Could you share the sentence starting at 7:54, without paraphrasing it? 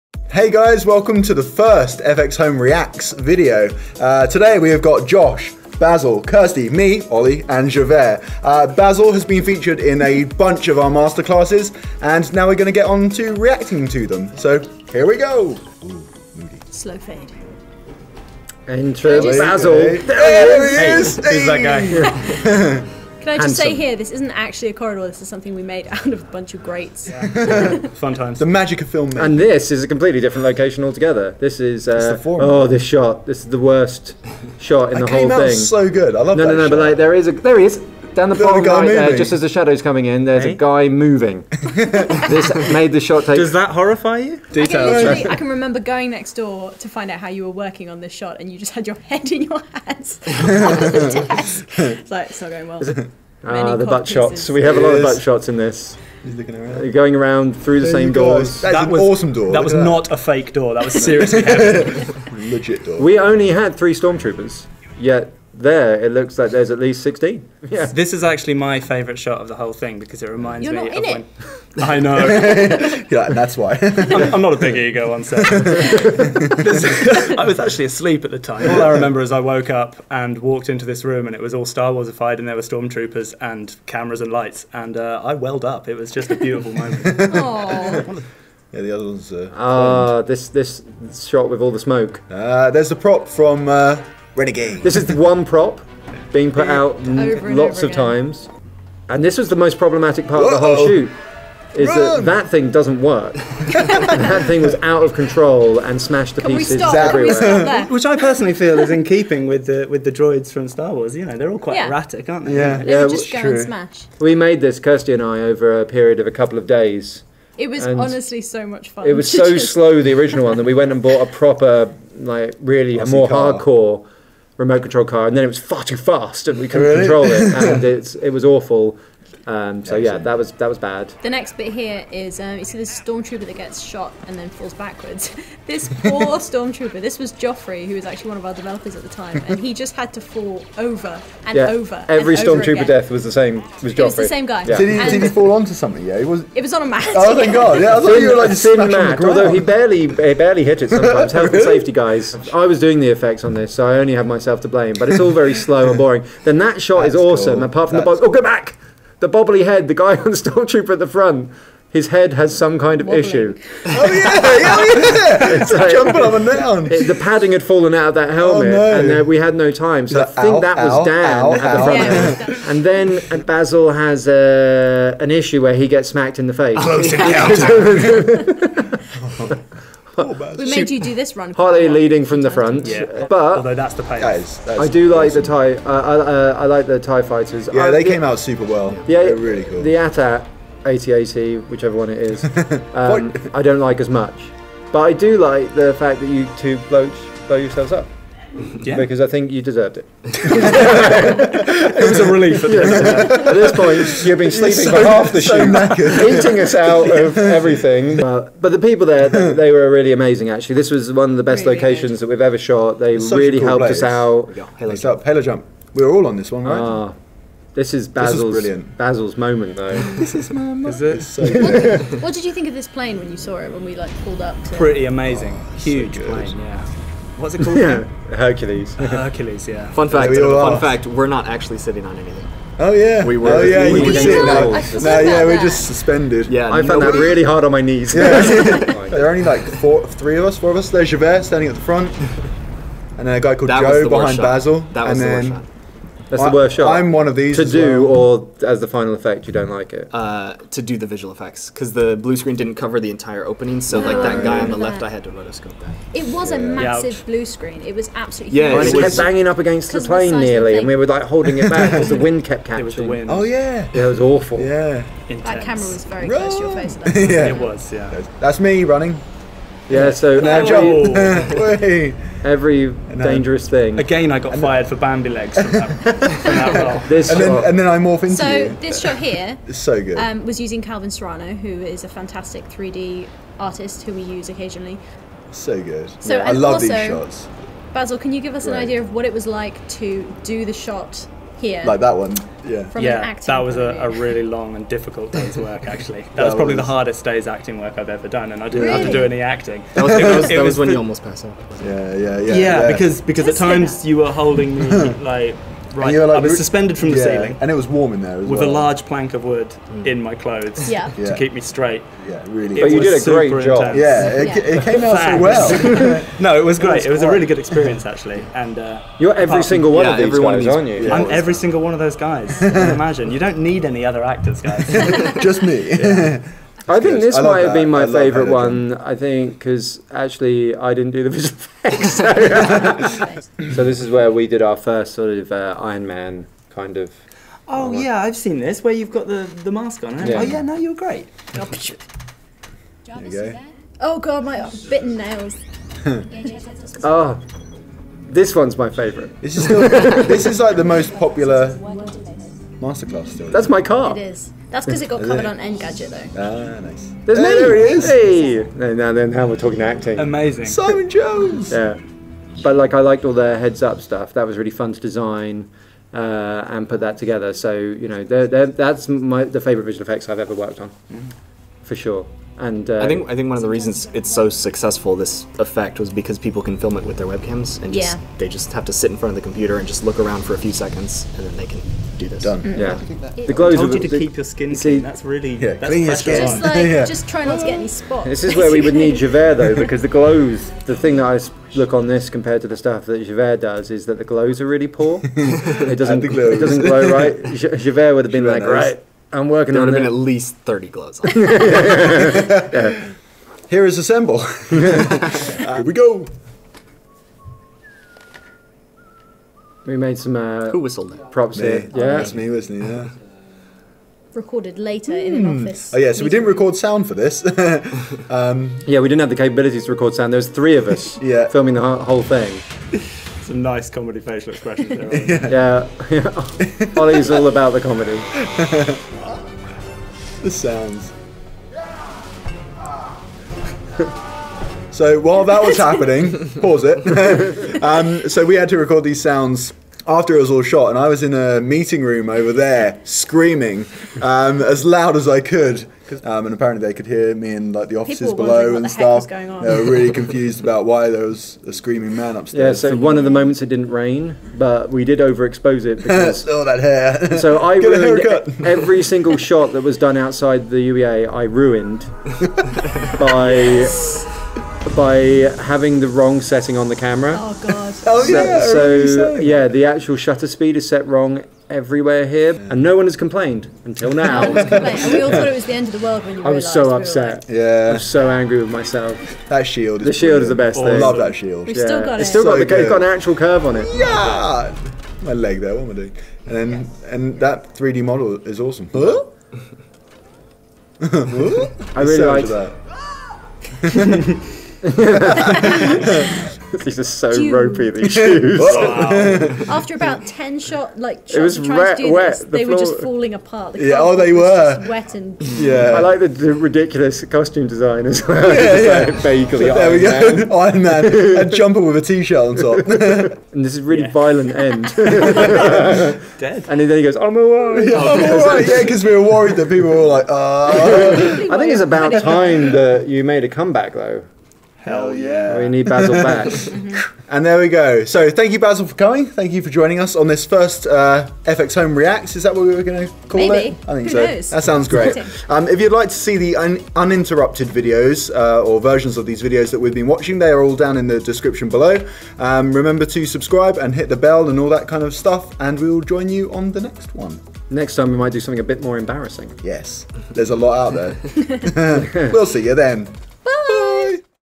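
no we all thought it was the end of the world when you.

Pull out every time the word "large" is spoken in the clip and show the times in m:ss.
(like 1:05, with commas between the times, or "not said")
5:08.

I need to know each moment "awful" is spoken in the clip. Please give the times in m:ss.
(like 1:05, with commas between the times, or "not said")
2:08, 4:24.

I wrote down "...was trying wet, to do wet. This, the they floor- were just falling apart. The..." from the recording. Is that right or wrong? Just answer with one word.
right.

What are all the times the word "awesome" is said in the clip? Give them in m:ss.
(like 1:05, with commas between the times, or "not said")
0:59, 2:37, 8:08.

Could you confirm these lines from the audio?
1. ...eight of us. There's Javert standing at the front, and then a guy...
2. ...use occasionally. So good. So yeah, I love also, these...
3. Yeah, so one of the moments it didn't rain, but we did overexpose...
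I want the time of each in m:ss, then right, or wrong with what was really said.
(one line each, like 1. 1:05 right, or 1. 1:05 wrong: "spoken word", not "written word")
1. 4:00 wrong: "four", not "eight"
2. 4:44 right
3. 7:32 right.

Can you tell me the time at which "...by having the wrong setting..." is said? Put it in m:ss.
7:44.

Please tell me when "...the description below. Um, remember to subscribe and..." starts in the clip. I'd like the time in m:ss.
9:01.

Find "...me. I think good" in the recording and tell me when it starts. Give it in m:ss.
5:25.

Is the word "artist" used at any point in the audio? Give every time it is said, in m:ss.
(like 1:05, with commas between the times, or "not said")
4:43.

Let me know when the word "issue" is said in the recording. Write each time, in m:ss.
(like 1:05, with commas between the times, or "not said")
2:43, 2:55.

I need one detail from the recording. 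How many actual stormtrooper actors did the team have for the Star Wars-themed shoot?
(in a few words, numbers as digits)
3.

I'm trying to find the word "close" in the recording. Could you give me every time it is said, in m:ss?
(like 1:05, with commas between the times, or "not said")
2:56, 4:26.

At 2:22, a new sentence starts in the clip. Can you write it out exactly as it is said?
Every stormtrooper death was the same.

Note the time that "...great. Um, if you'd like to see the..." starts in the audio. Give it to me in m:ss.
8:54.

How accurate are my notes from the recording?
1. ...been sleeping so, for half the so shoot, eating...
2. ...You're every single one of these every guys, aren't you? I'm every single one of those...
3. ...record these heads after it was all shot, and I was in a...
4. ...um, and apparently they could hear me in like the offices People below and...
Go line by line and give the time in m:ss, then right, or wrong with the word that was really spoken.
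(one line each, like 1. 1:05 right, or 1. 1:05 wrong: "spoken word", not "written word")
1. 3:24 right
2. 5:19 right
3. 7:18 wrong: "sounds", not "heads"
4. 7:26 right.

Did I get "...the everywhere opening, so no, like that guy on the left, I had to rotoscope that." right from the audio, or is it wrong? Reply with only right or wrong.
wrong.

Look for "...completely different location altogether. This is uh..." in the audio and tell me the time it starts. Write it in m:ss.
0:29.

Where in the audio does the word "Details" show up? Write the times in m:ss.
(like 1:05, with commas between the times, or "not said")
0:44.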